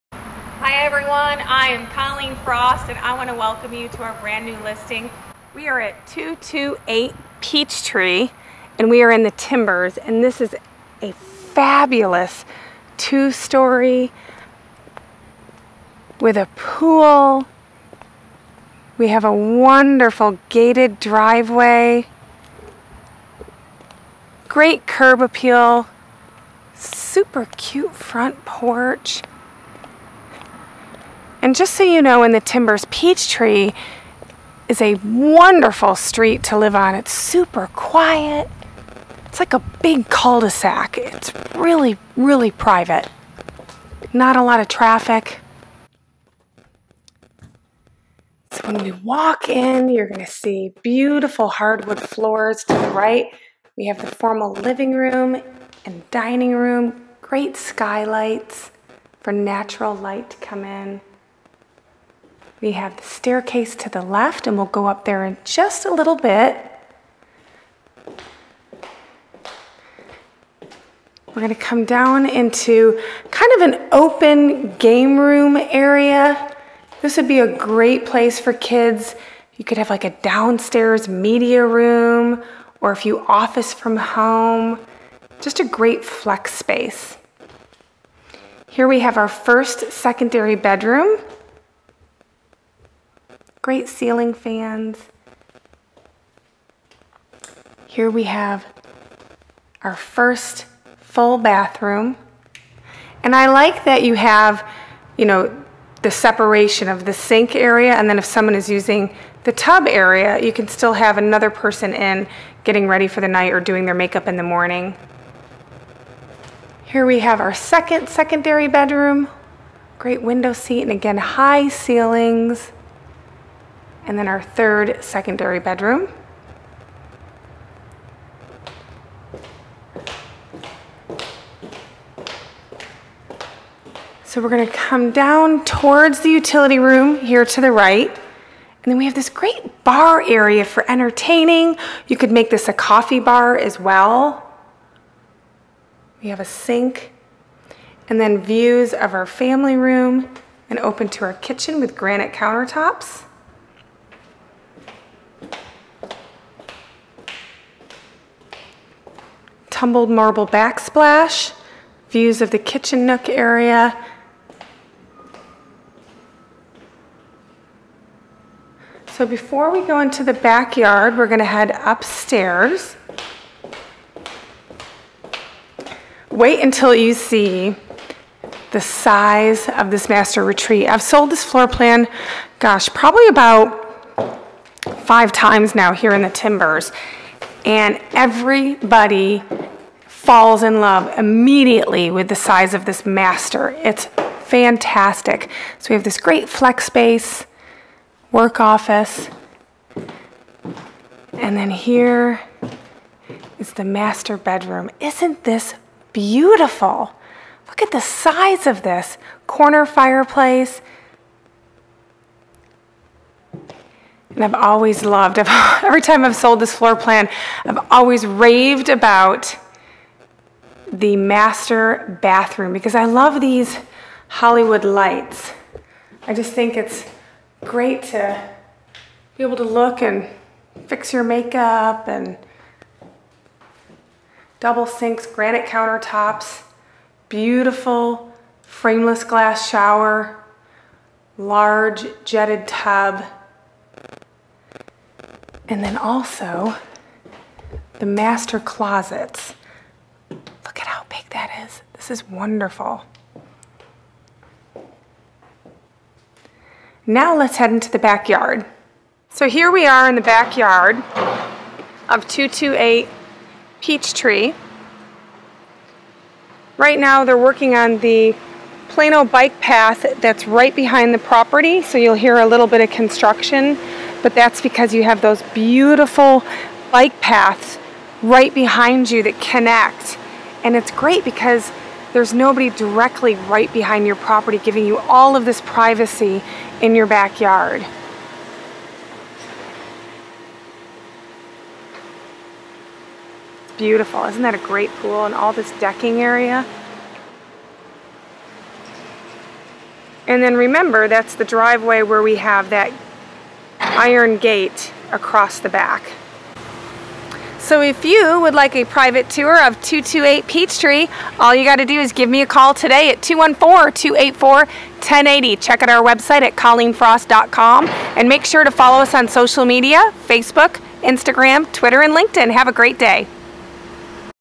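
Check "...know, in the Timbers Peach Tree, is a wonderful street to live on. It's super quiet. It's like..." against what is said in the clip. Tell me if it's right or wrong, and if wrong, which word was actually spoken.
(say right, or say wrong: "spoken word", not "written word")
right.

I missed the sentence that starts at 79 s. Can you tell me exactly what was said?
You could have like a downstairs media room, or if you office from home, just a great flex space.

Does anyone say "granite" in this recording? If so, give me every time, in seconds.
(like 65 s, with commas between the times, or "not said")
151 s, 235 s.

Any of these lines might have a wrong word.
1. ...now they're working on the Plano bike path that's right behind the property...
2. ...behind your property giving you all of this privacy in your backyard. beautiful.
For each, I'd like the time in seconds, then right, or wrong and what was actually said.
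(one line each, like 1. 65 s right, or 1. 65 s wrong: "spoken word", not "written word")
1. 266 s right
2. 283 s right.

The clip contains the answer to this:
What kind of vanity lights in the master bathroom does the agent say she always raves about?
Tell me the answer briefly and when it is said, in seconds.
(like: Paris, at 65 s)
Hollywood lights, at 224 s.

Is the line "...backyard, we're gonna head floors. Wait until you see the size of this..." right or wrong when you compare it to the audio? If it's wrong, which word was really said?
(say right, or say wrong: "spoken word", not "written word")
wrong: "upstairs", not "floors".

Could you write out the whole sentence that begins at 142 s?
You could make this a coffee bar as well.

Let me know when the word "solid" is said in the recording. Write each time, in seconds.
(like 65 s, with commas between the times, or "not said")
not said.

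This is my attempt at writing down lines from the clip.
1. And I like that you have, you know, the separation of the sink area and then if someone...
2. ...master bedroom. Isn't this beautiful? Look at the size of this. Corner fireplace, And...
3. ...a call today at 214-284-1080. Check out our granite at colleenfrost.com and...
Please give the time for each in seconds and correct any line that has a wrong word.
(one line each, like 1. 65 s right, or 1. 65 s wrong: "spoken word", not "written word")
1. 103 s right
2. 203 s right
3. 312 s wrong: "website", not "granite".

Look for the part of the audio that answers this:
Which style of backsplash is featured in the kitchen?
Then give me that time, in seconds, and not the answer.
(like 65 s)
159 s.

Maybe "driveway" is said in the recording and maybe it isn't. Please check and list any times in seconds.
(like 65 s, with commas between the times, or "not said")
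20 s, 301 s.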